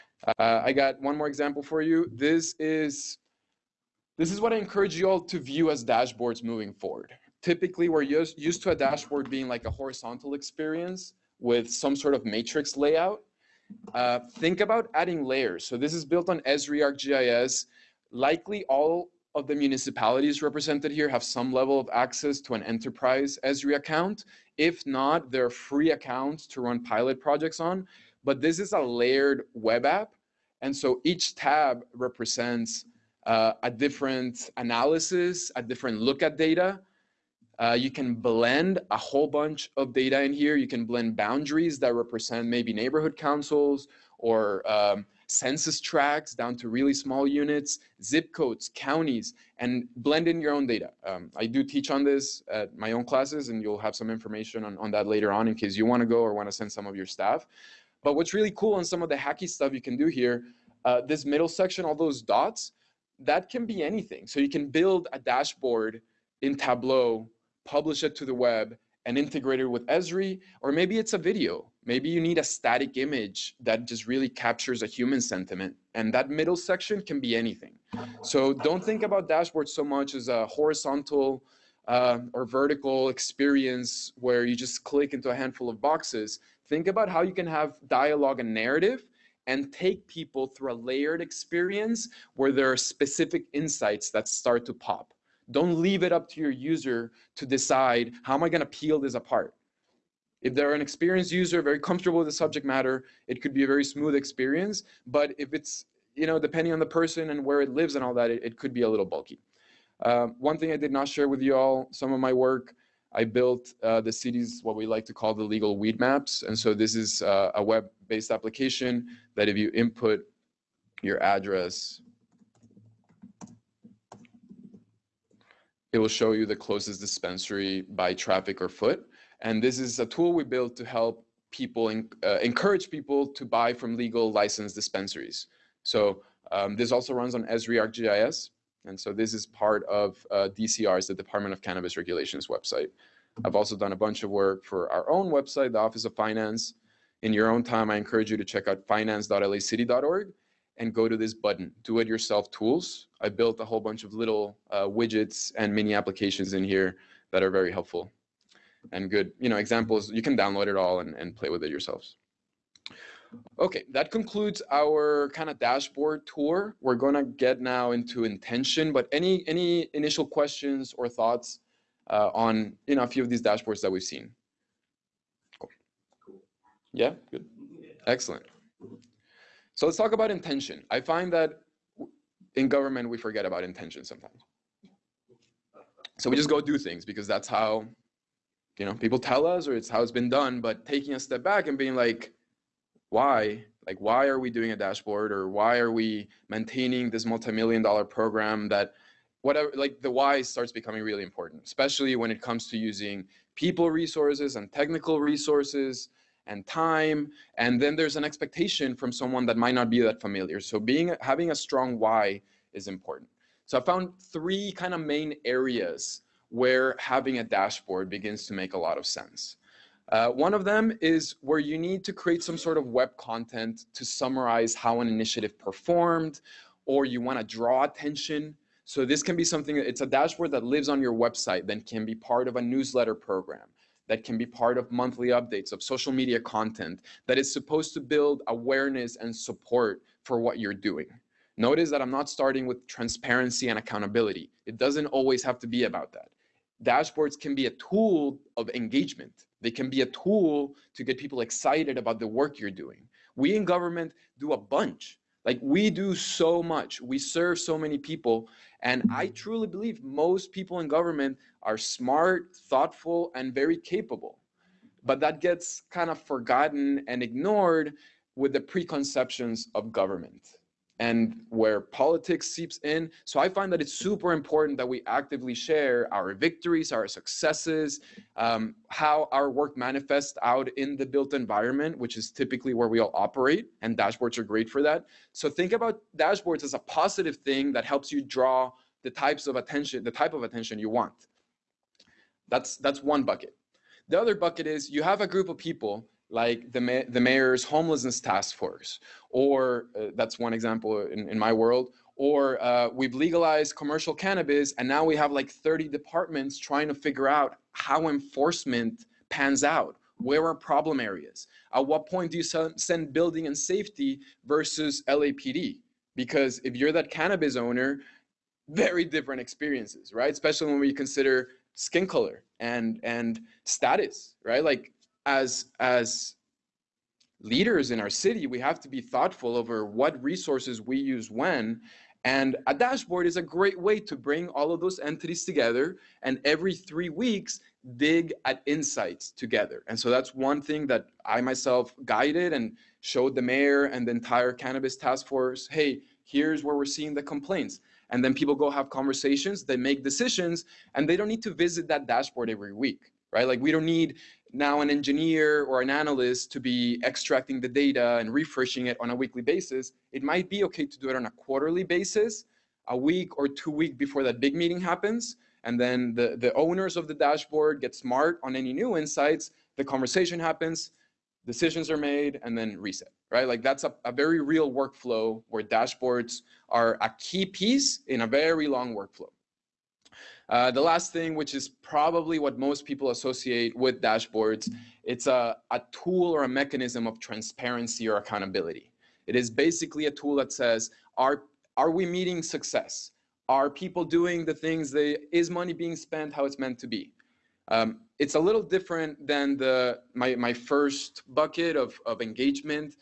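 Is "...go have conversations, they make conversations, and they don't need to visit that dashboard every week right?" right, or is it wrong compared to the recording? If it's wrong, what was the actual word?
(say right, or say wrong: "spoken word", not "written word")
wrong: "decisions", not "conversations".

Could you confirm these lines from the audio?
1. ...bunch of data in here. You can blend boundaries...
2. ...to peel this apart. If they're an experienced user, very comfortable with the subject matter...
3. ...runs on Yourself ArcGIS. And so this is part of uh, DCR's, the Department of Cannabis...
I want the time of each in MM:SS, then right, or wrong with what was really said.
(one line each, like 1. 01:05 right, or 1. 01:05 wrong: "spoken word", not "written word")
1. 00:39 right
2. 01:38 right
3. 02:17 wrong: "Esri", not "Yourself".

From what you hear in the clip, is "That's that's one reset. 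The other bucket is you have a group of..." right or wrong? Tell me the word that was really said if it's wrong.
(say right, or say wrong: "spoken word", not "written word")
wrong: "bucket", not "reset".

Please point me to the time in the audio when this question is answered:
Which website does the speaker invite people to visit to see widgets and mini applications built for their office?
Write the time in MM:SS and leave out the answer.
02:28.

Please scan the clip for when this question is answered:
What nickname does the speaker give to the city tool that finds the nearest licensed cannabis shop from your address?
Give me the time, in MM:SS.
01:55.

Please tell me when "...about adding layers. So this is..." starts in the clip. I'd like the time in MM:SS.
00:14.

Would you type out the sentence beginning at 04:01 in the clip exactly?
Notice that I'm not starting with transparency and accountability.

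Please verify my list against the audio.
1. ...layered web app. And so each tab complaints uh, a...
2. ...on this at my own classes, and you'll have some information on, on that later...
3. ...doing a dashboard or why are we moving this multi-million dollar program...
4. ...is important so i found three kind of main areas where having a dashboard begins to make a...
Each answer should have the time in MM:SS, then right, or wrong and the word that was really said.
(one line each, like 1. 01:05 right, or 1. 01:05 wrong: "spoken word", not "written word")
1. 00:28 wrong: "represents", not "complaints"
2. 00:51 right
3. 03:14 wrong: "maintaining", not "moving"
4. 03:32 right.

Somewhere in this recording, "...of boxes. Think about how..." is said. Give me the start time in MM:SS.
01:25.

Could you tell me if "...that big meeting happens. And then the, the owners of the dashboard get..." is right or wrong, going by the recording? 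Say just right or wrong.
right.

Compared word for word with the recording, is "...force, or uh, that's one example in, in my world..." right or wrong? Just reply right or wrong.
right.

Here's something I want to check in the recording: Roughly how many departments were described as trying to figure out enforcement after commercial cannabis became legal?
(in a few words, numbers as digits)
30.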